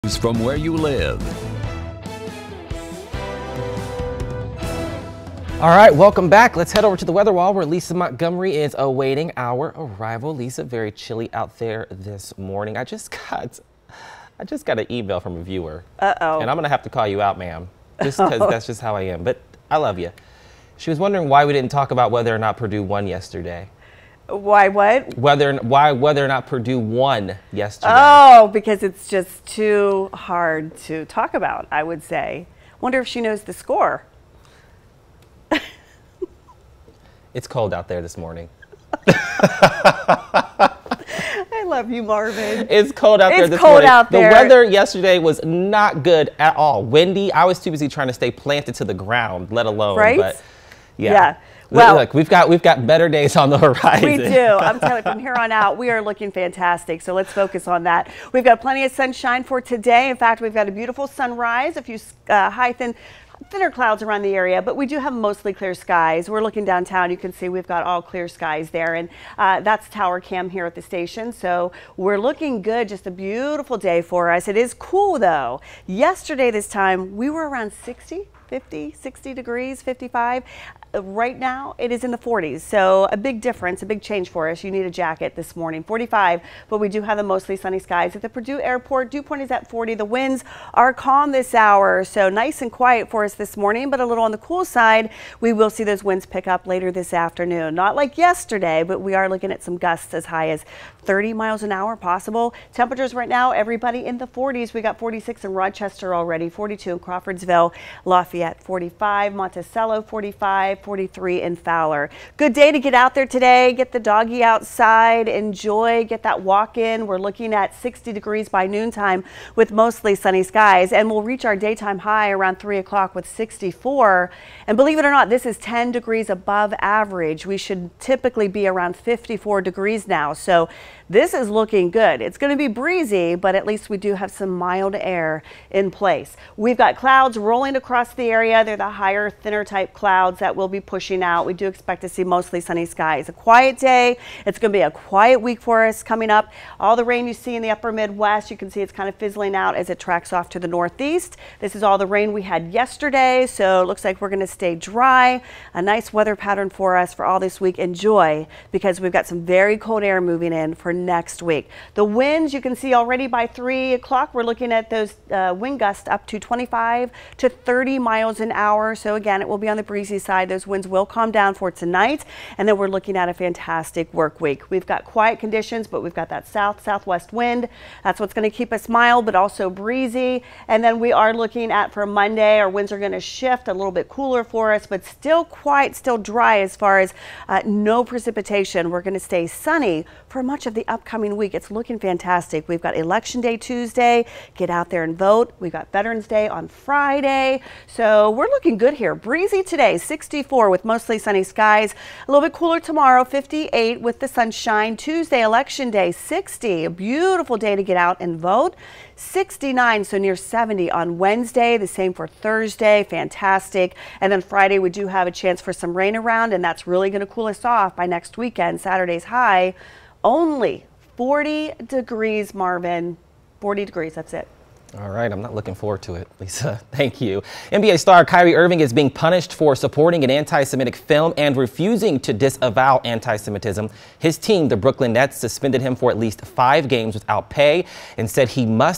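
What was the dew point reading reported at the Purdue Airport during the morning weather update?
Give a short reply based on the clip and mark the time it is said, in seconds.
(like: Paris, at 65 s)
40, at 89 s.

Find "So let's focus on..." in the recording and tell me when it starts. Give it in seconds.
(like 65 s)
57 s.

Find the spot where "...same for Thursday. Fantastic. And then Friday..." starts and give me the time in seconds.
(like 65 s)
211 s.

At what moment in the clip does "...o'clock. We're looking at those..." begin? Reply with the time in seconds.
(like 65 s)
163 s.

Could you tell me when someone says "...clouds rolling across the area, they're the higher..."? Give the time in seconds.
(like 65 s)
136 s.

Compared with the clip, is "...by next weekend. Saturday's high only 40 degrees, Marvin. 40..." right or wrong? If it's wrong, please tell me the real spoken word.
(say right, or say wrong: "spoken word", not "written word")
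right.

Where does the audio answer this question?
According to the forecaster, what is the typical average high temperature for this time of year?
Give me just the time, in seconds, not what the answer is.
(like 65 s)
128 s.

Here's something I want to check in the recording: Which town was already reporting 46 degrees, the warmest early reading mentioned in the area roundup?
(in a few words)
Rochester.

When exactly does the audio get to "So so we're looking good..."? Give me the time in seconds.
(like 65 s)
197 s.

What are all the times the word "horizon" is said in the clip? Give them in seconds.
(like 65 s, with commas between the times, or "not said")
53 s.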